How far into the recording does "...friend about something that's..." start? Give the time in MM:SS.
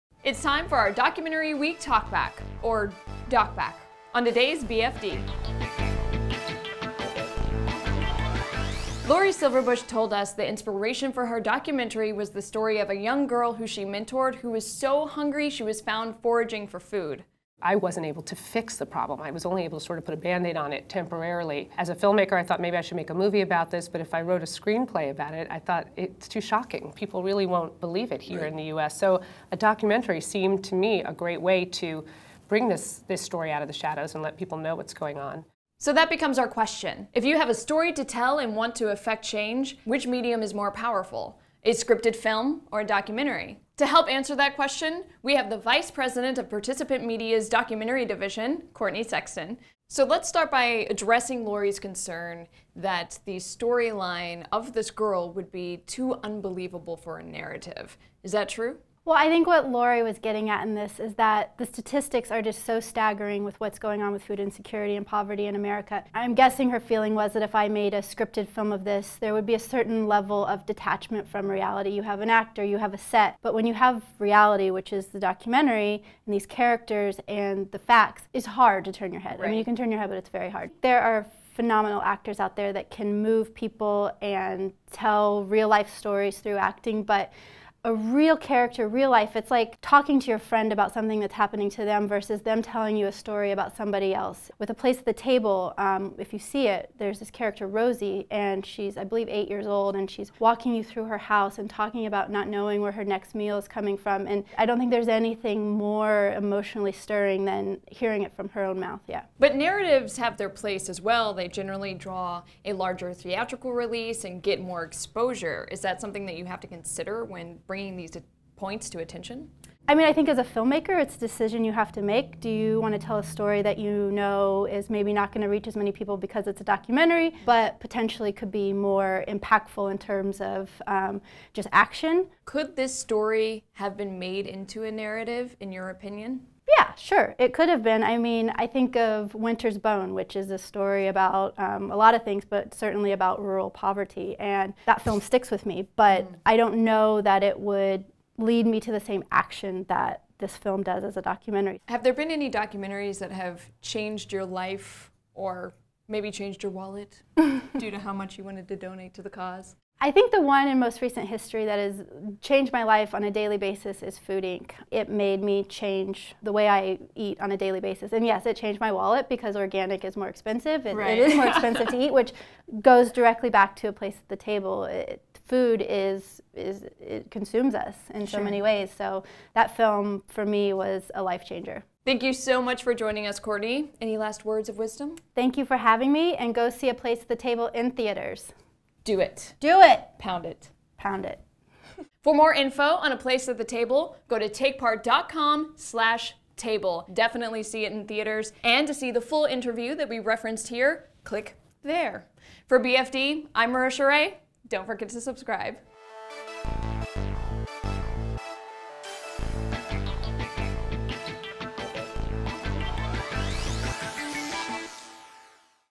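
01:30.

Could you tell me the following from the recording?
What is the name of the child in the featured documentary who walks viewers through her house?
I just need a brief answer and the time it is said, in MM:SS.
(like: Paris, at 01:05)
Rosie, at 01:37.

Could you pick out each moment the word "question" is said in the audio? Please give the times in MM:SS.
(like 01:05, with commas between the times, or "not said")
00:36, 00:44.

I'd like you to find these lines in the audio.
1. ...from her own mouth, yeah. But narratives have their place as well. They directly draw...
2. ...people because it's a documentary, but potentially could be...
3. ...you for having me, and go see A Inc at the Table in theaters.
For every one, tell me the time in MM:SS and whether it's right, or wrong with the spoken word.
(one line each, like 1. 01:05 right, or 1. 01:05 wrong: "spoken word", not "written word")
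1. 01:48 wrong: "generally", not "directly"
2. 02:05 right
3. 03:05 wrong: "Place", not "Inc".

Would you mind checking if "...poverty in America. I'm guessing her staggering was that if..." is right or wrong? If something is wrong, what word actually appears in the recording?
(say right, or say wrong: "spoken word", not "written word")
wrong: "feeling", not "staggering".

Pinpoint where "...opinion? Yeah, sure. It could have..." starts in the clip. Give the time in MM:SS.
02:15.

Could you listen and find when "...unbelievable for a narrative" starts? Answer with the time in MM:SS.
00:56.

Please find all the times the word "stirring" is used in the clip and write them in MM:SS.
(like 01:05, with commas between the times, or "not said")
01:46.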